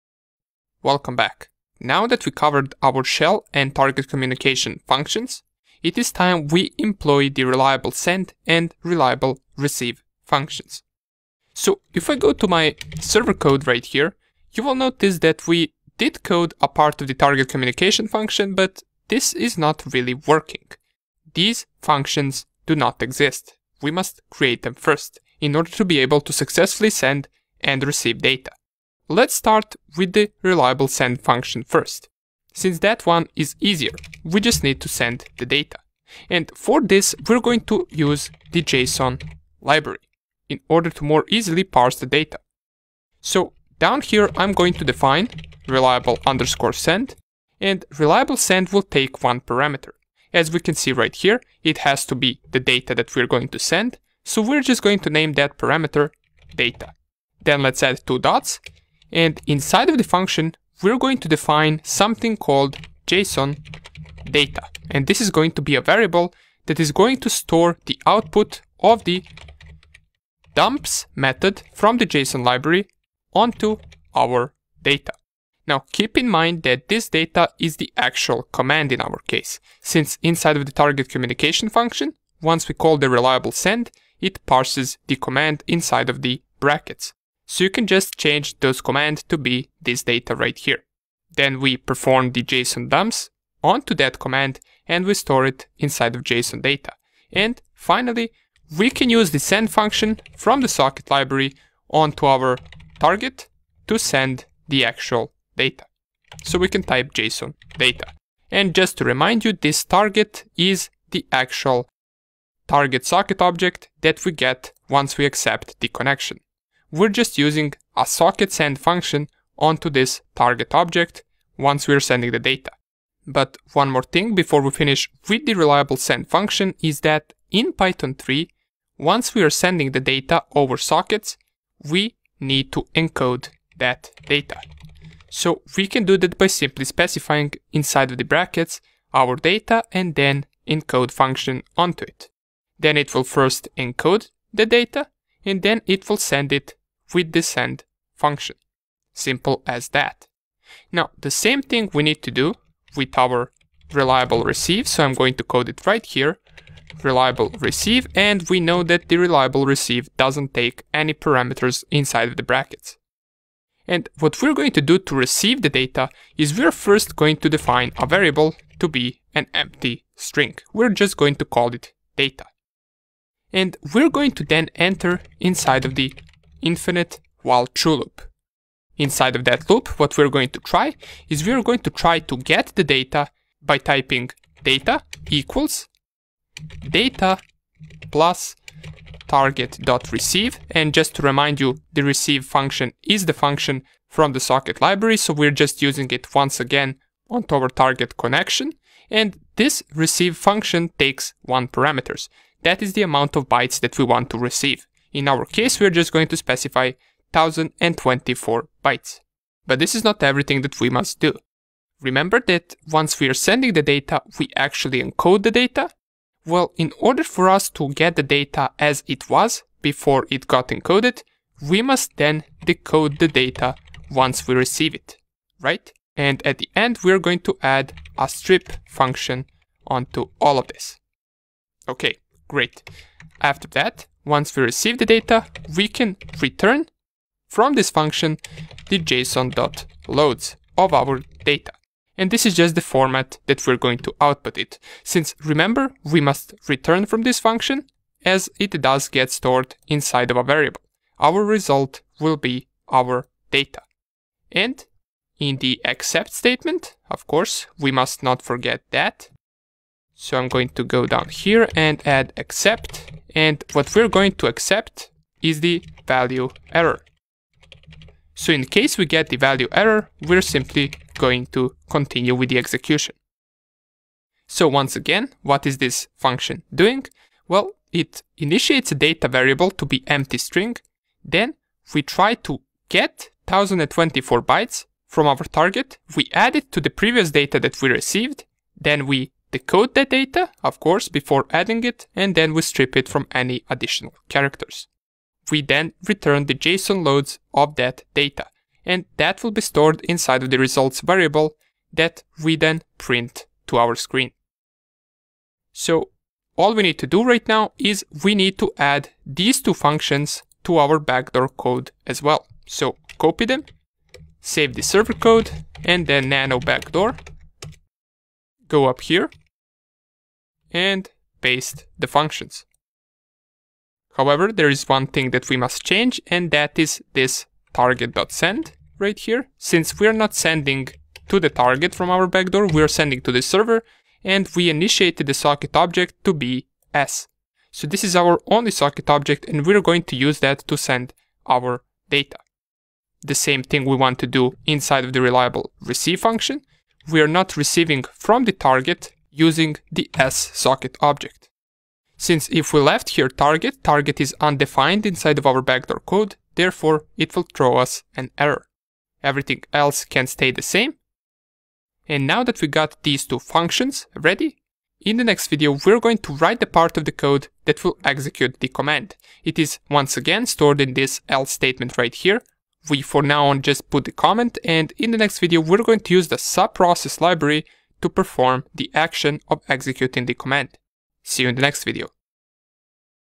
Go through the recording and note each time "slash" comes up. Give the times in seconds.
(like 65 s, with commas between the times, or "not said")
not said.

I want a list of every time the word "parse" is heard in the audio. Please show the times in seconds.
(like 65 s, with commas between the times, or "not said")
41 s, 84 s.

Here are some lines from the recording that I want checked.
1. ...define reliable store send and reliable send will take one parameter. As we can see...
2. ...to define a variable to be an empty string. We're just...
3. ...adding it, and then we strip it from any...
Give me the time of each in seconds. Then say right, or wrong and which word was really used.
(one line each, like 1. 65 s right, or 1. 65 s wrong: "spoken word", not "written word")
1. 44 s wrong: "underscore", not "store"
2. 167 s right
3. 291 s right.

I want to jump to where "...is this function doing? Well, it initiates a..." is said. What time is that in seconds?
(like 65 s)
275 s.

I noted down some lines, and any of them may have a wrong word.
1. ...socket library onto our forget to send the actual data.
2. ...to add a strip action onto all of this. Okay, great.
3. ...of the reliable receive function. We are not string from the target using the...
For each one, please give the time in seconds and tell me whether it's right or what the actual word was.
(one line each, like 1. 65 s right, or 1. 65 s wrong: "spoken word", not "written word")
1. 100 s wrong: "target", not "forget"
2. 227 s wrong: "function", not "action"
3. 345 s wrong: "receiving", not "string".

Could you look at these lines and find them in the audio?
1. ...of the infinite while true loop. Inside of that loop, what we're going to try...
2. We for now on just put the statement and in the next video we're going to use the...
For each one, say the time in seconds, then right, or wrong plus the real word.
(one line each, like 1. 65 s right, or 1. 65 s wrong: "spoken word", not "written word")
1. 175 s right
2. 372 s wrong: "comment", not "statement".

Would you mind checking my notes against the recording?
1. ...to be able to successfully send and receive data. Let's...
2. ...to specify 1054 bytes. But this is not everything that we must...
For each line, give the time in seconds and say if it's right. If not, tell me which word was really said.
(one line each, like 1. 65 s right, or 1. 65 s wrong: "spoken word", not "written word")
1. 25 s right
2. 206 s wrong: "1024", not "1054".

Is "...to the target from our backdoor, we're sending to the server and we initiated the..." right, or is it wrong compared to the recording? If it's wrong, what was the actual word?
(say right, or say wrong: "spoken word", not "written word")
right.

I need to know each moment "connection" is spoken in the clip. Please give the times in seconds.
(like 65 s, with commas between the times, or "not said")
115 s, 198 s.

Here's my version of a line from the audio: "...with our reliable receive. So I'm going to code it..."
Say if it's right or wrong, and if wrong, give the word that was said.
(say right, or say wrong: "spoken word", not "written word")
right.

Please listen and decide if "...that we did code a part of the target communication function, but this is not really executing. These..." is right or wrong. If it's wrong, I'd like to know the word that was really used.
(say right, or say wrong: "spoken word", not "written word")
wrong: "working", not "executing".